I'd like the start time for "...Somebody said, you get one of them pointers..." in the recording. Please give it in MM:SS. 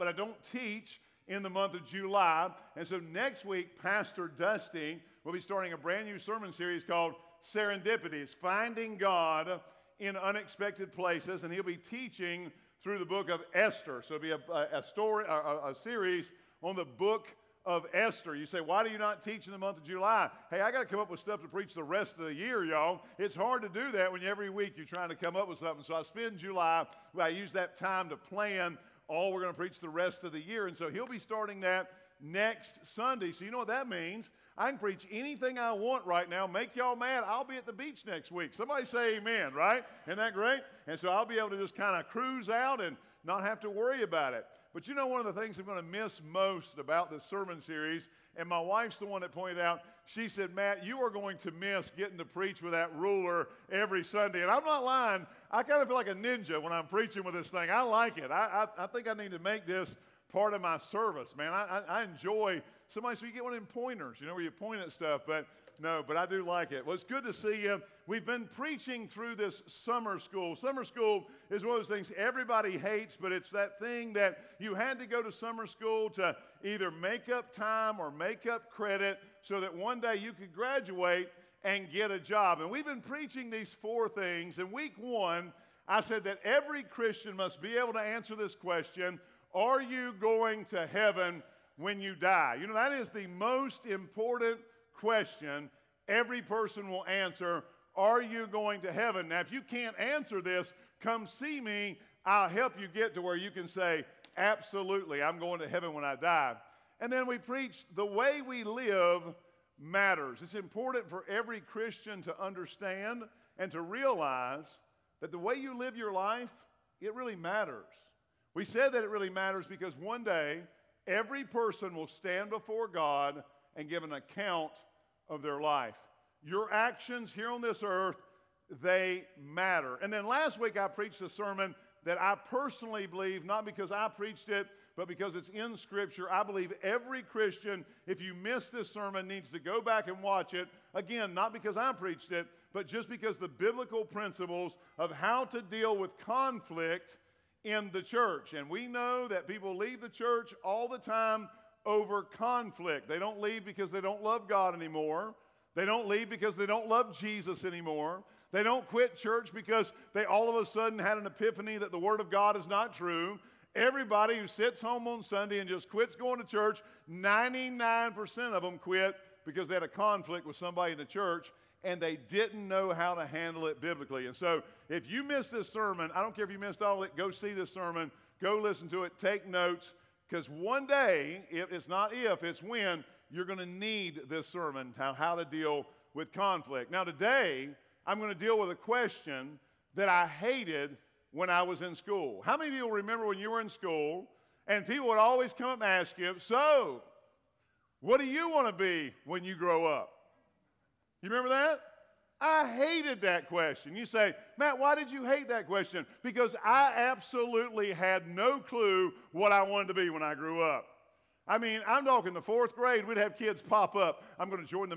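01:02.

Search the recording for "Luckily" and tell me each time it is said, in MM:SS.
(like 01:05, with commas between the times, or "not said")
not said.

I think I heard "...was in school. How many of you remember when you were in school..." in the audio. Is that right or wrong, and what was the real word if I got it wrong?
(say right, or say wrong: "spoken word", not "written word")
right.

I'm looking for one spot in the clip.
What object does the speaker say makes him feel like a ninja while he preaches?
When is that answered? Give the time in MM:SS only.
00:52.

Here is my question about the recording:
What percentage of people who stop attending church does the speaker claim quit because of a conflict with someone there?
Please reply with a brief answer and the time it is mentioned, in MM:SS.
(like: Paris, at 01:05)
99%, at 02:47.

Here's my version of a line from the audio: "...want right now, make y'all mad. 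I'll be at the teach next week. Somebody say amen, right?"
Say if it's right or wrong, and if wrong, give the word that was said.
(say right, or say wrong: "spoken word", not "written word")
wrong: "beach", not "teach".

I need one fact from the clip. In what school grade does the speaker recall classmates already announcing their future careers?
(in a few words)
Fourth grade.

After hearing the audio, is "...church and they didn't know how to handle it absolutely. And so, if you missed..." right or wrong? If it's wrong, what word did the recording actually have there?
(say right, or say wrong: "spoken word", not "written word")
wrong: "biblically", not "absolutely".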